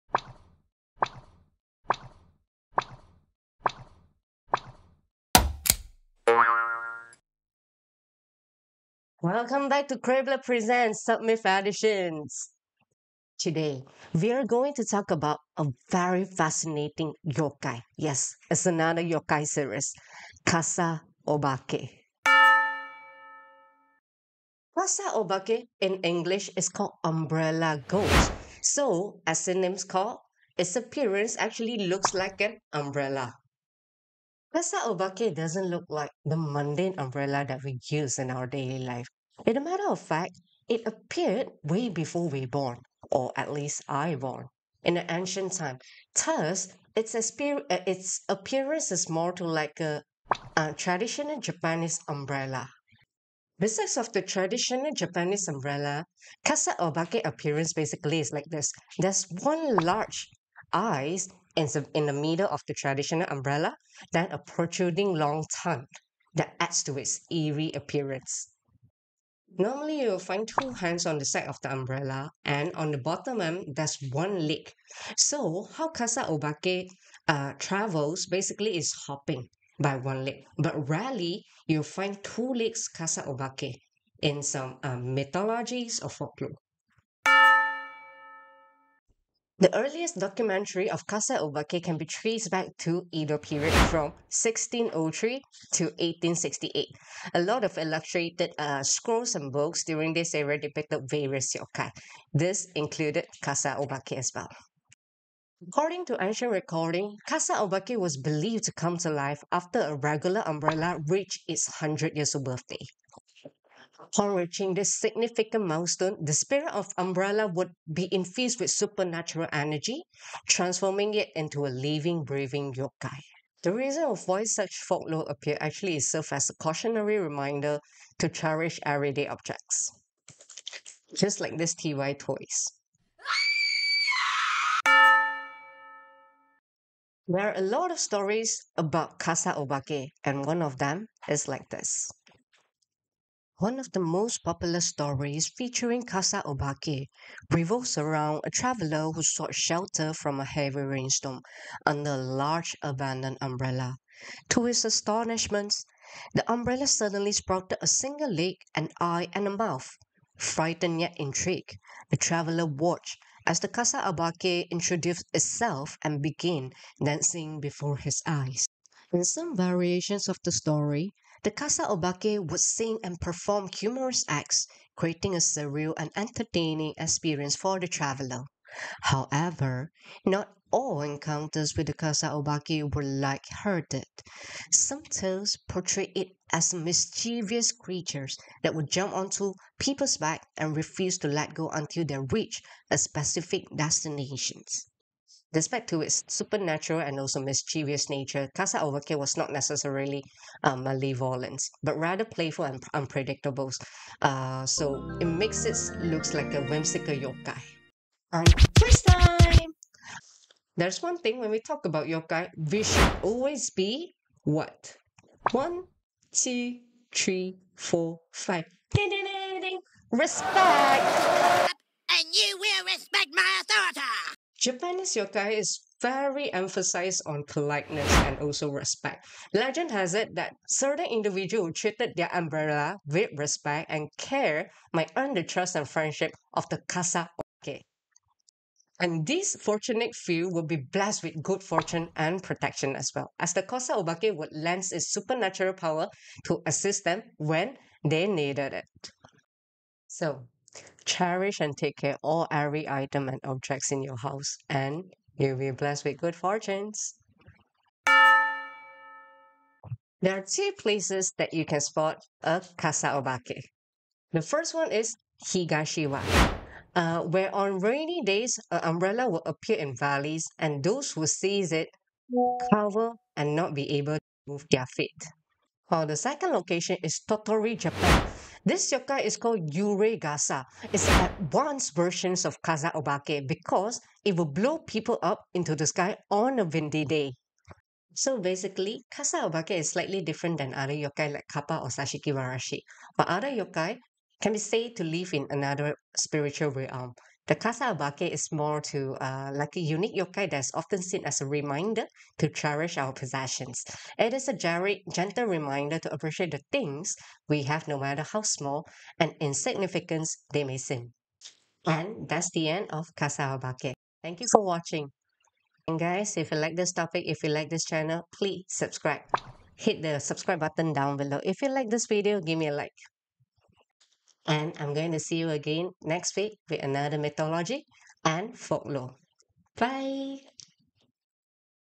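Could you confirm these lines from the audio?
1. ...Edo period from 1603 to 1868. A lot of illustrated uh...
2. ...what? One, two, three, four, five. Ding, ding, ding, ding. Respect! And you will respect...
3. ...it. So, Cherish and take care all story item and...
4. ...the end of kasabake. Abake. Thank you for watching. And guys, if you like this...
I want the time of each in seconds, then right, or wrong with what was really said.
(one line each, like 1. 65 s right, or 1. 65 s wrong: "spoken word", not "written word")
1. 93 s right
2. 214 s right
3. 248 s wrong: "every", not "story"
4. 312 s right.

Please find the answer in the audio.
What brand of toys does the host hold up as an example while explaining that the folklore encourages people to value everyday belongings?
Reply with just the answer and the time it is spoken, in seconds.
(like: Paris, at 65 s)
TY, at 131 s.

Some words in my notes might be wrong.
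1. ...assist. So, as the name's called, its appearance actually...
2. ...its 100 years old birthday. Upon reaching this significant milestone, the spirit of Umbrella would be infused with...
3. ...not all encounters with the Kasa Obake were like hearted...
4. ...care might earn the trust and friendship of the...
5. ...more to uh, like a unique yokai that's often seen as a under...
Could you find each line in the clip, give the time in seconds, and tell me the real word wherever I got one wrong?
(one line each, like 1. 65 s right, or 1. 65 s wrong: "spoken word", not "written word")
1. 27 s wrong: "ghost", not "assist"
2. 111 s right
3. 180 s right
4. 234 s right
5. 298 s wrong: "reminder", not "under".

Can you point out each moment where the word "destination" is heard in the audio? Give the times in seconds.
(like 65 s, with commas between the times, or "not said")
193 s.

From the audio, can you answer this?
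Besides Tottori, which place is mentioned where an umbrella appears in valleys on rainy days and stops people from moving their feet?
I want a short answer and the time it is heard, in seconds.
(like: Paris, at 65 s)
Higashiwa, at 265 s.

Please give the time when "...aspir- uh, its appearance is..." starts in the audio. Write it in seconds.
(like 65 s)
47 s.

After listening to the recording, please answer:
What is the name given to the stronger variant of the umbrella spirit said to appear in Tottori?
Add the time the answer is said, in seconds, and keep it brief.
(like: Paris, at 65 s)
Yuregasa, at 279 s.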